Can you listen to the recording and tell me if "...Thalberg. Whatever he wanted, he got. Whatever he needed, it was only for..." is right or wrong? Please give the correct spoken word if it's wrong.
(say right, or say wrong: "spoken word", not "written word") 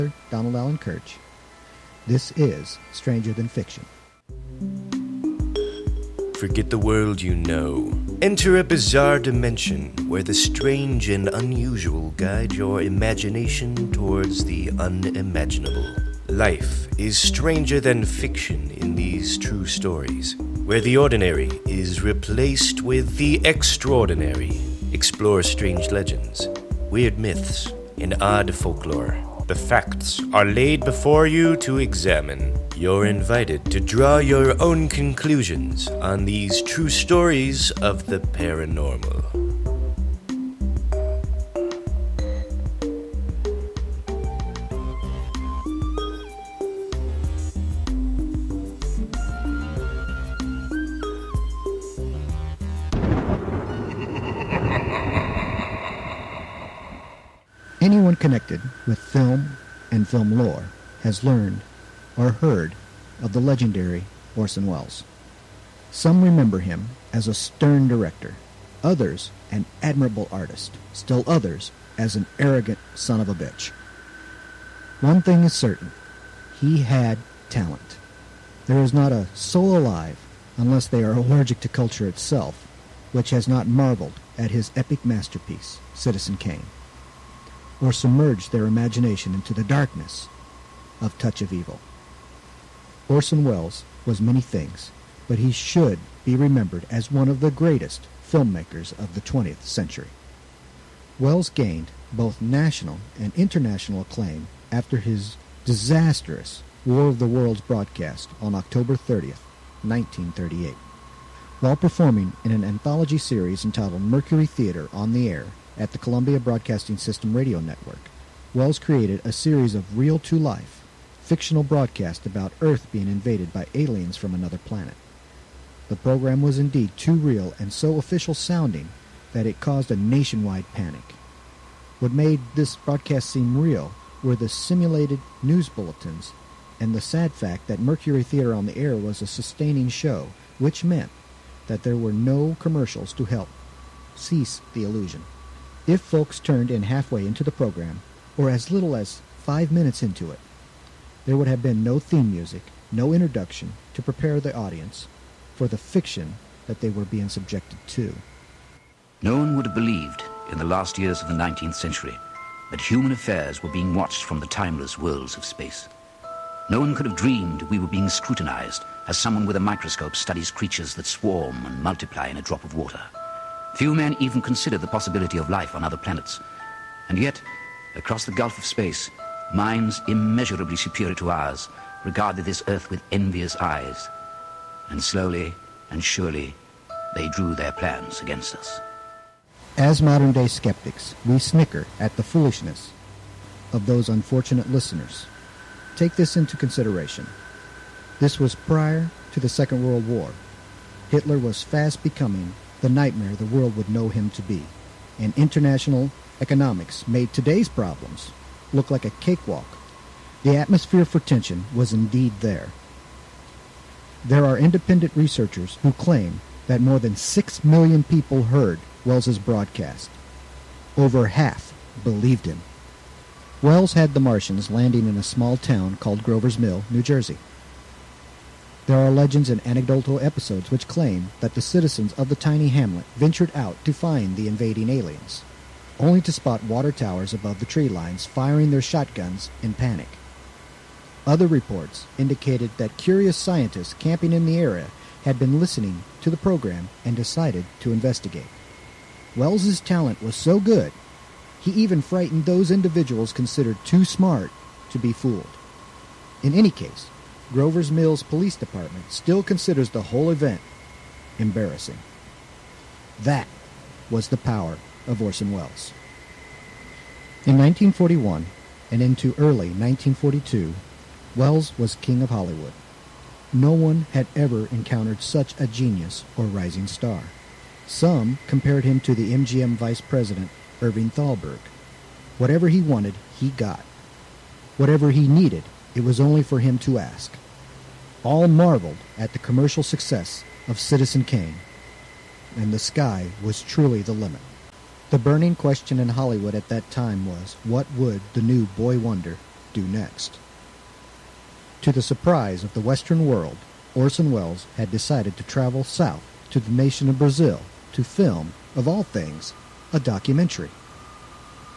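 right.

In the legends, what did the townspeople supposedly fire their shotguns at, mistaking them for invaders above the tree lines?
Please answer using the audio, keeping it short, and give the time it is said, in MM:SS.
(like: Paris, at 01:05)
water towers, at 03:56.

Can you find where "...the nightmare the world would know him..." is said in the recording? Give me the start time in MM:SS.
03:22.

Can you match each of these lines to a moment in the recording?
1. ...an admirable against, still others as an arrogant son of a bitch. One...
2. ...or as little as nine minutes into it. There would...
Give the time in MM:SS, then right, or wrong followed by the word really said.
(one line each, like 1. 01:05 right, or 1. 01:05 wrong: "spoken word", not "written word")
1. 01:09 wrong: "artist", not "against"
2. 02:28 wrong: "five", not "nine".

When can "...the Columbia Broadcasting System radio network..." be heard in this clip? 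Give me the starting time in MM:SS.
01:55.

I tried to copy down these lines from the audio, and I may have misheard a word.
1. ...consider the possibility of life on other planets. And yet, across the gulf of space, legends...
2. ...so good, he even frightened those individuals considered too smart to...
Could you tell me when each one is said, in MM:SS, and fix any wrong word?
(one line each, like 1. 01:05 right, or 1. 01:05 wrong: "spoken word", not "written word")
1. 02:54 wrong: "minds", not "legends"
2. 04:10 right.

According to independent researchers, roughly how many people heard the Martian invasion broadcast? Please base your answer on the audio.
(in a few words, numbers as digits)
more than 6 million.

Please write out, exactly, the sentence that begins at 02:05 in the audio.
The program was indeed too real and so official sounding that it caused a nationwide panic.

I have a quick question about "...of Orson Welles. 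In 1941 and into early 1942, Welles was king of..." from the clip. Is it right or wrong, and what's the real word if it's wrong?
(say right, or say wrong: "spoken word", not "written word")
right.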